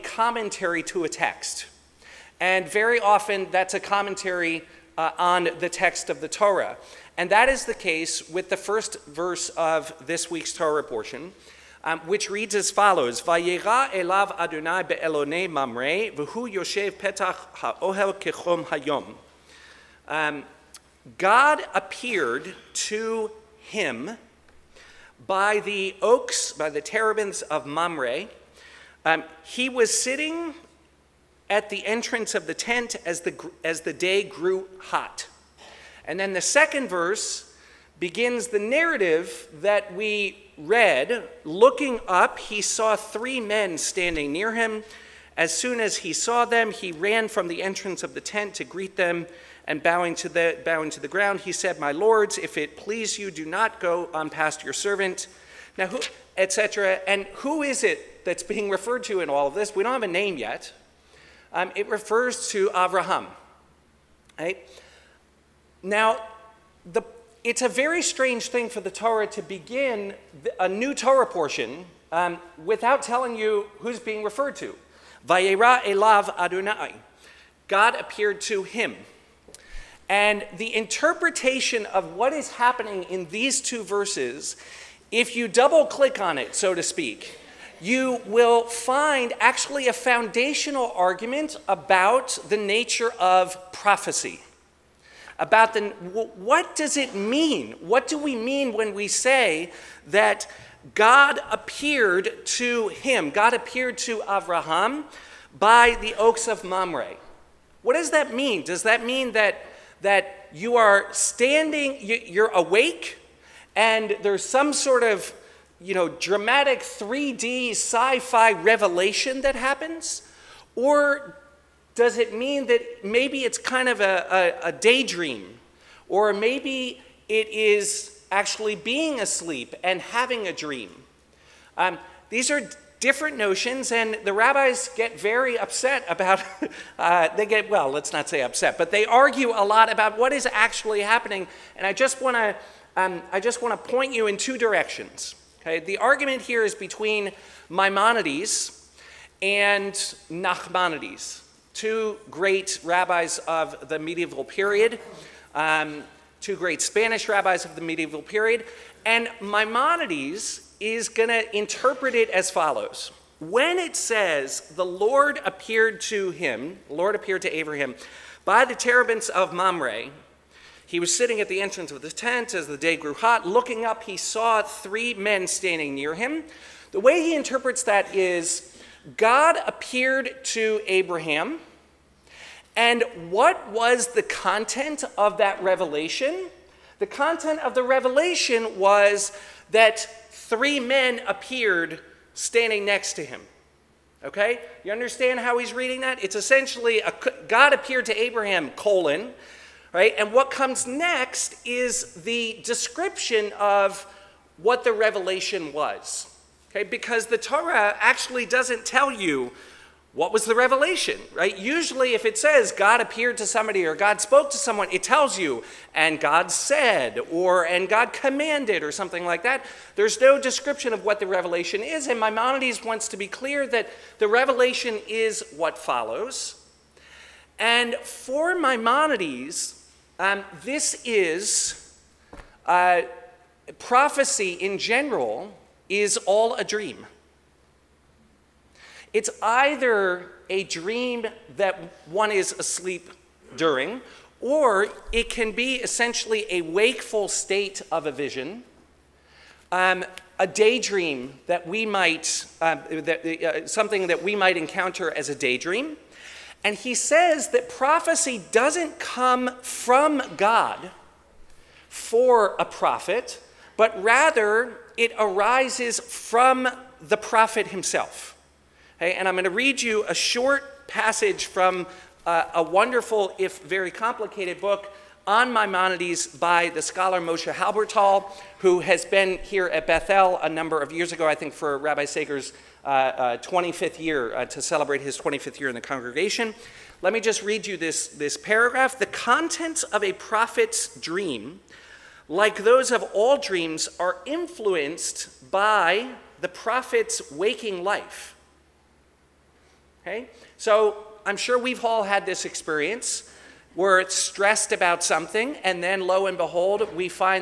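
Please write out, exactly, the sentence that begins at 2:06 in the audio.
Or maybe it is actually being asleep and having a dream?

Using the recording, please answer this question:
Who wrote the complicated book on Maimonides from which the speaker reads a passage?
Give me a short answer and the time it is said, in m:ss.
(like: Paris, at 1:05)
Moshe Halbertal, at 4:37.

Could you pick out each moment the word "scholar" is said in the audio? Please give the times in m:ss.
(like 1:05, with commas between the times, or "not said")
4:36.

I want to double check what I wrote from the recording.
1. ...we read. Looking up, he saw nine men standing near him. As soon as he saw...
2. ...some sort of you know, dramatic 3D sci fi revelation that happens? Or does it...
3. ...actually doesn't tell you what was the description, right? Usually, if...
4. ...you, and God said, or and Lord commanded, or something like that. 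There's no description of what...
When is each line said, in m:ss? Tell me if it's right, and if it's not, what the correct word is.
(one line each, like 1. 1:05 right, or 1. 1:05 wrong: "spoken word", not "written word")
1. 0:39 wrong: "three", not "nine"
2. 1:54 right
3. 3:27 wrong: "revelation", not "description"
4. 3:35 wrong: "God", not "Lord".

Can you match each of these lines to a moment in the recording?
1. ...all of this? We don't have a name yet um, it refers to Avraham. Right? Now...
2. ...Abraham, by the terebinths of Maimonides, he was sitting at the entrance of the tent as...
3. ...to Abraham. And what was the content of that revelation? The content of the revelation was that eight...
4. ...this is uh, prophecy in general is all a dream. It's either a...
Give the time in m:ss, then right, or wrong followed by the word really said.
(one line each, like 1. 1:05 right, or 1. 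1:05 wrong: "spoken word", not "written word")
1. 0:59 right
2. 2:47 wrong: "Mamre", not "Maimonides"
3. 3:00 wrong: "three", not "eight"
4. 3:50 right.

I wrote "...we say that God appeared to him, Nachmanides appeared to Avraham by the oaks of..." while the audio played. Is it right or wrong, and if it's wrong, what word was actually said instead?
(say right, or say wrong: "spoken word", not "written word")
wrong: "God", not "Nachmanides".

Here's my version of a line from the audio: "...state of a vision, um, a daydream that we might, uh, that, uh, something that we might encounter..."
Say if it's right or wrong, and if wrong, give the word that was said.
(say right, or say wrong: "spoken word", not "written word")
right.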